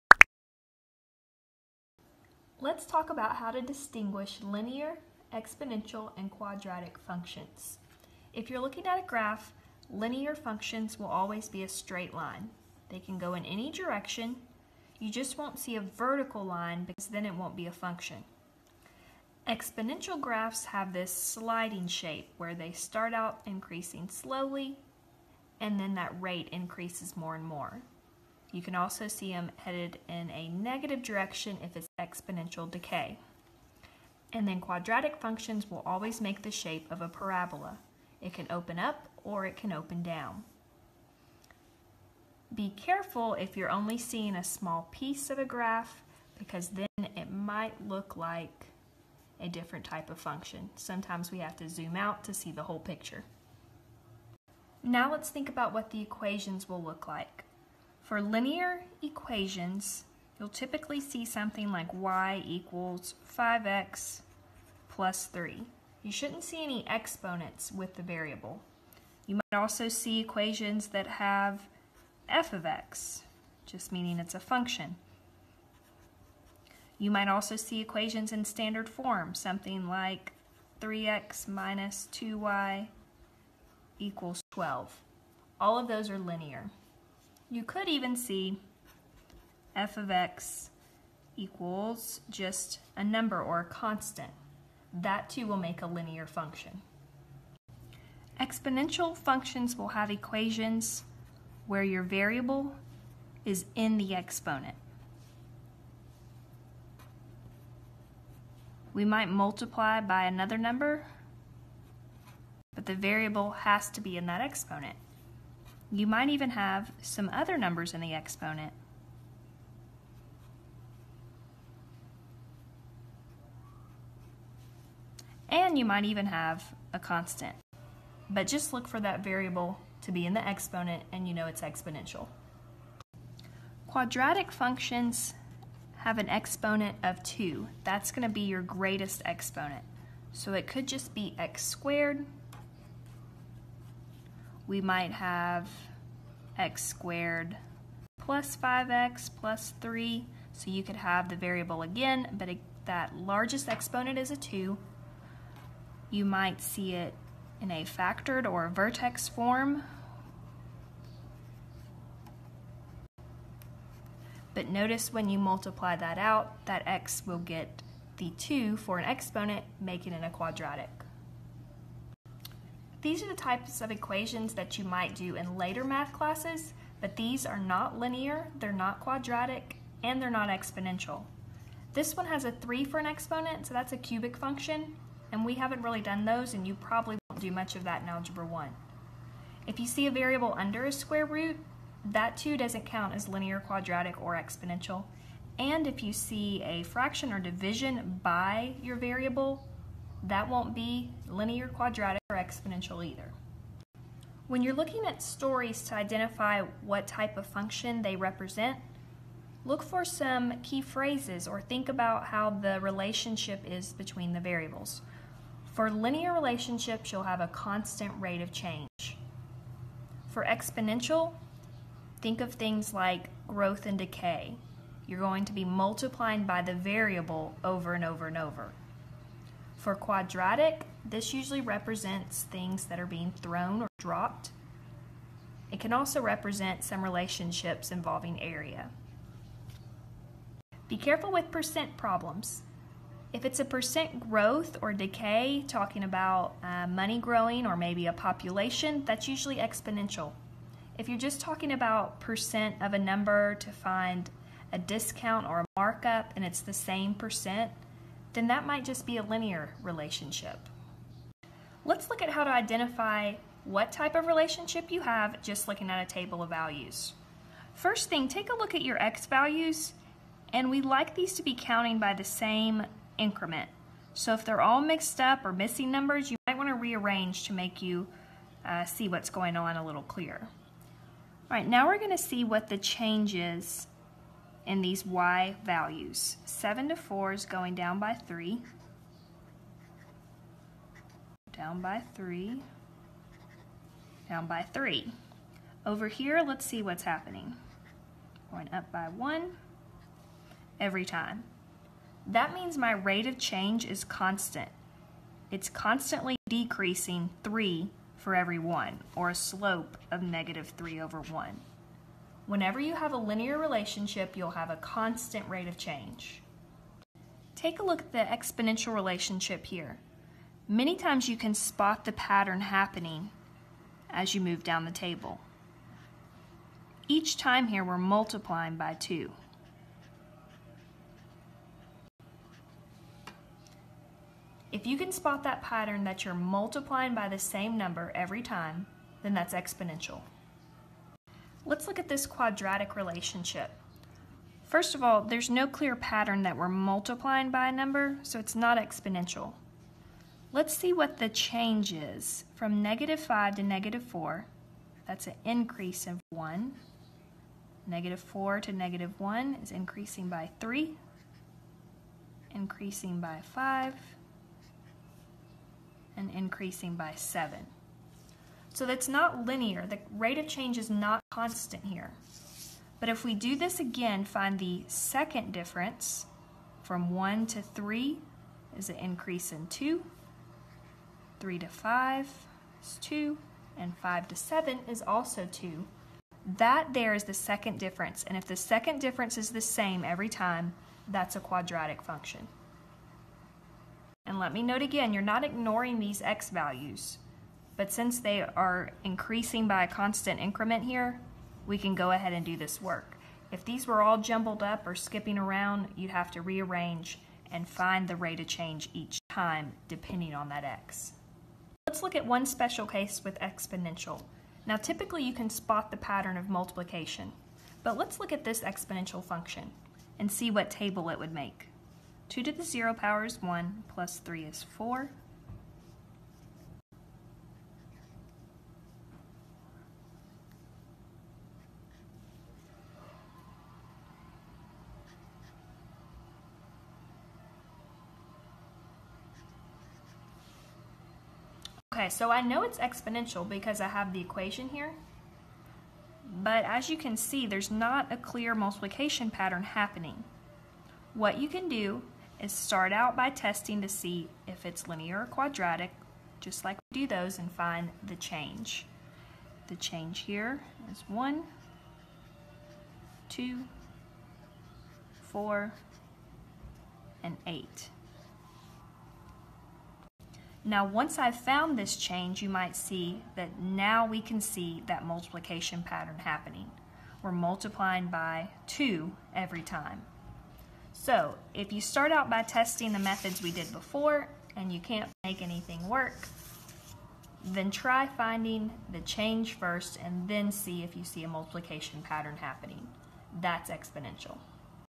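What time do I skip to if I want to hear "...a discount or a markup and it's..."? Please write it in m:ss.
4:14.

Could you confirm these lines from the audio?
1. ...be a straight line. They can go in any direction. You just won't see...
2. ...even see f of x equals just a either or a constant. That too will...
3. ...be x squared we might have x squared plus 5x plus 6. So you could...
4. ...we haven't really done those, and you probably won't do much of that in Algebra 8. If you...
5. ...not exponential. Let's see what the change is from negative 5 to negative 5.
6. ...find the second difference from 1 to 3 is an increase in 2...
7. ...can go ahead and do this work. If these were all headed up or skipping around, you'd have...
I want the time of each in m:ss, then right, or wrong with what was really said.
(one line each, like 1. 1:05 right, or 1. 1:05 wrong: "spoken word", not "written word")
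1. 0:11 right
2. 1:27 wrong: "number", not "either"
3. 2:21 wrong: "3", not "6"
4. 3:05 wrong: "1", not "8"
5. 5:48 wrong: "4", not "5"
6. 6:14 right
7. 6:41 wrong: "jumbled", not "headed".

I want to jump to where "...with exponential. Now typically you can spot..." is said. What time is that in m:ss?
6:53.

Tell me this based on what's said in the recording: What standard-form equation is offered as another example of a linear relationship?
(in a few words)
3x - 2y = 12.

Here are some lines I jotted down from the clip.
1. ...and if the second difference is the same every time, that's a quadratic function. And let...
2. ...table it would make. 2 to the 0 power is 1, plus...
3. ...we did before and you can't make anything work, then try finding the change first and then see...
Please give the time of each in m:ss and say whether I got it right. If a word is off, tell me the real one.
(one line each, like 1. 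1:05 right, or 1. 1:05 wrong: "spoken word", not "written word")
1. 6:28 right
2. 7:00 right
3. 8:03 right.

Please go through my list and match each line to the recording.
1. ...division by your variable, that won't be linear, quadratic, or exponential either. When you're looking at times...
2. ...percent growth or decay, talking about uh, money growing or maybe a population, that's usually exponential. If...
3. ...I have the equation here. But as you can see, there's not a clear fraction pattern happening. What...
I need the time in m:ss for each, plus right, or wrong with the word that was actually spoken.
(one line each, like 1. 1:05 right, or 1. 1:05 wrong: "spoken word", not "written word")
1. 3:17 wrong: "stories", not "times"
2. 4:03 right
3. 7:23 wrong: "multiplication", not "fraction".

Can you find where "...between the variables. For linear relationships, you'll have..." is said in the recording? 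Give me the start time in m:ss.
3:33.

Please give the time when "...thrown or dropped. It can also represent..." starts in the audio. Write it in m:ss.
3:53.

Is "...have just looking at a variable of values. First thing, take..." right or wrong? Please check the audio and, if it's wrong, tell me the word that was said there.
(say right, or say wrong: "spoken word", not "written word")
wrong: "table", not "variable".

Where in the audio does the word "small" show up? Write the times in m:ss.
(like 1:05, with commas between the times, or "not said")
0:44.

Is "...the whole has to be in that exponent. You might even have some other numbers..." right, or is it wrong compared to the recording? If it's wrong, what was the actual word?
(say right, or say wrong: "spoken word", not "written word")
wrong: "variable", not "whole".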